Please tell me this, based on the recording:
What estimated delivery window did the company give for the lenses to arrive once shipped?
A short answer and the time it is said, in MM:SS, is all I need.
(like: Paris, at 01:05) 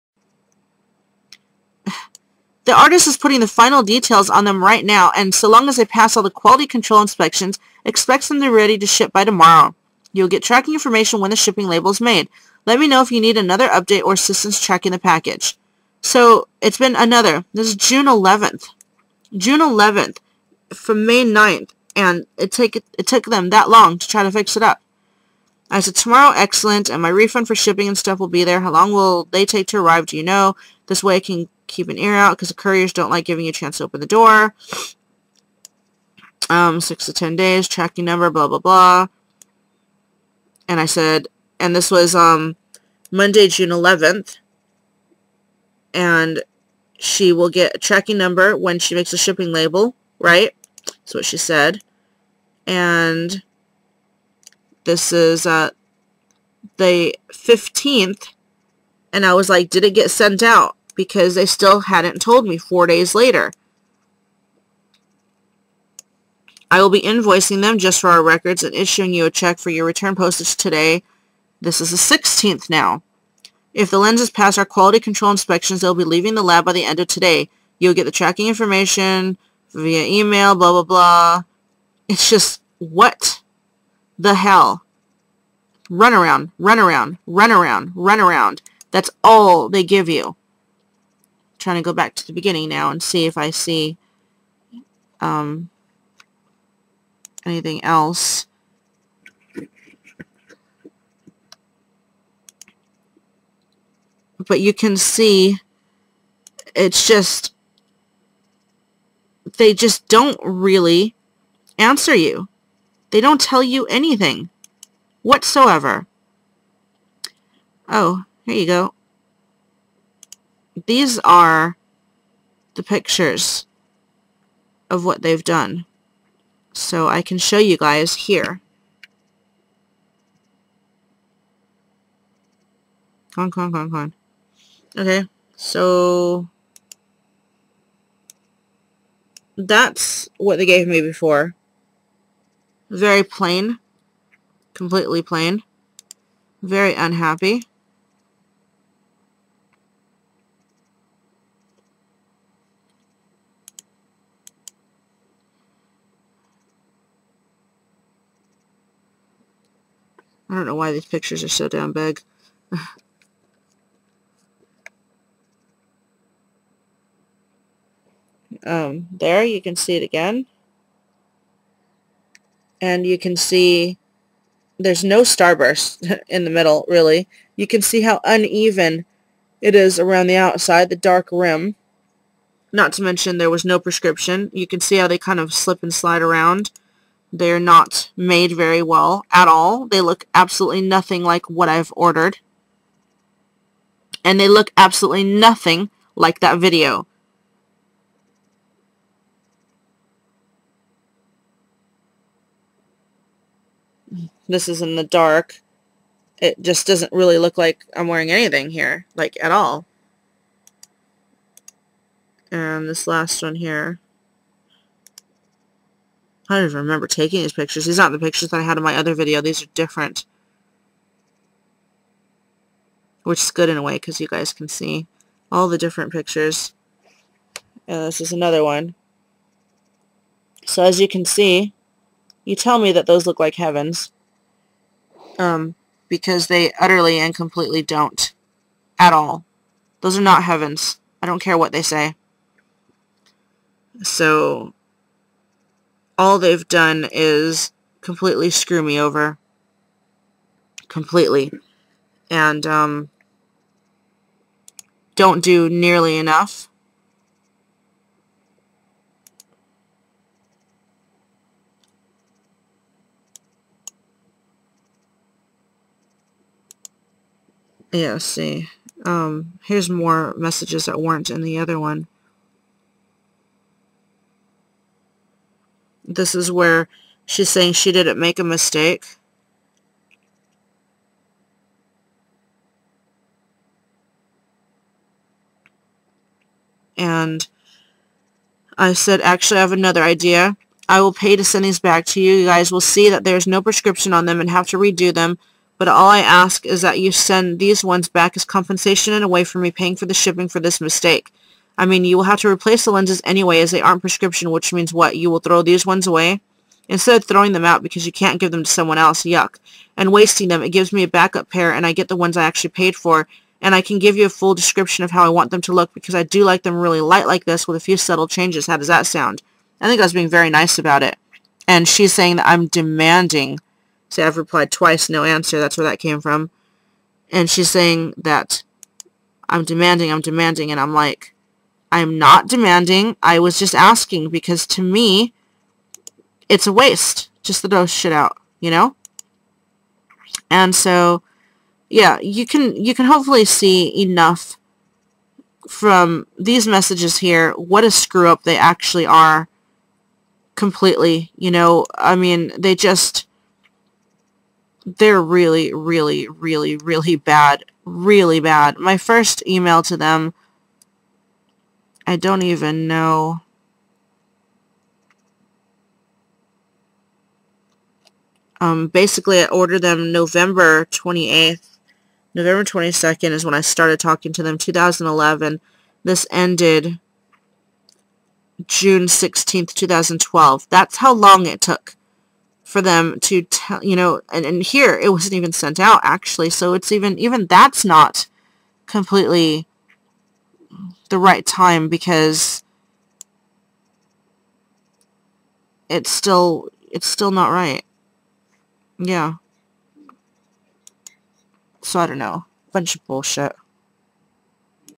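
6 to 10 days, at 00:36.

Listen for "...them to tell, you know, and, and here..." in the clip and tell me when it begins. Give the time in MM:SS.
06:22.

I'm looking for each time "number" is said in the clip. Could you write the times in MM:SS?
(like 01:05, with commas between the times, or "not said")
00:38, 00:48.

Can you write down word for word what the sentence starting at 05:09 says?
And wasting them, it gives me a backup pair and I get the ones I actually paid for.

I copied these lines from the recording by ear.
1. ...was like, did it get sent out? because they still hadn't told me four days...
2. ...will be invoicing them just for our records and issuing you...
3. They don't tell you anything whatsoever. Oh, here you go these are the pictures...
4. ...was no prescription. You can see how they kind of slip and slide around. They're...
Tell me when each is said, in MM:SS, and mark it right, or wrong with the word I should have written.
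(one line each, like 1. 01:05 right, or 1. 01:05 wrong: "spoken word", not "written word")
1. 00:59 right
2. 01:06 right
3. 01:53 right
4. 03:03 right.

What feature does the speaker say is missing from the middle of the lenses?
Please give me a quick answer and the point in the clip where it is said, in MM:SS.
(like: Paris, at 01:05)
starburst, at 02:55.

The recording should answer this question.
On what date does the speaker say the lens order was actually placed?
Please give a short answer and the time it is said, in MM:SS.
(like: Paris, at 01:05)
November 28th, at 06:10.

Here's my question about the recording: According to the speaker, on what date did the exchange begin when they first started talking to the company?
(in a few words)
November 22nd, 2011.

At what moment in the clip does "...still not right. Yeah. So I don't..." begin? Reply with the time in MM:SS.
06:37.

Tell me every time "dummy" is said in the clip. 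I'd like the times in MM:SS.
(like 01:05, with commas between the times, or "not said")
not said.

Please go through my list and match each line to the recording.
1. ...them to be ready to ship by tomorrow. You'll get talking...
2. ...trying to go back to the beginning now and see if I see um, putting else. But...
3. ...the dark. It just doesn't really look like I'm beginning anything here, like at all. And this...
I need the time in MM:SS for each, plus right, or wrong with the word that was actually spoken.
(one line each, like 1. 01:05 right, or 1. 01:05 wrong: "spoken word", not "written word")
1. 00:08 wrong: "tracking", not "talking"
2. 01:31 wrong: "anything", not "putting"
3. 03:24 wrong: "wearing", not "beginning".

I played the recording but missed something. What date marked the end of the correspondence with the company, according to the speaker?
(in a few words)
June 16th, 2012.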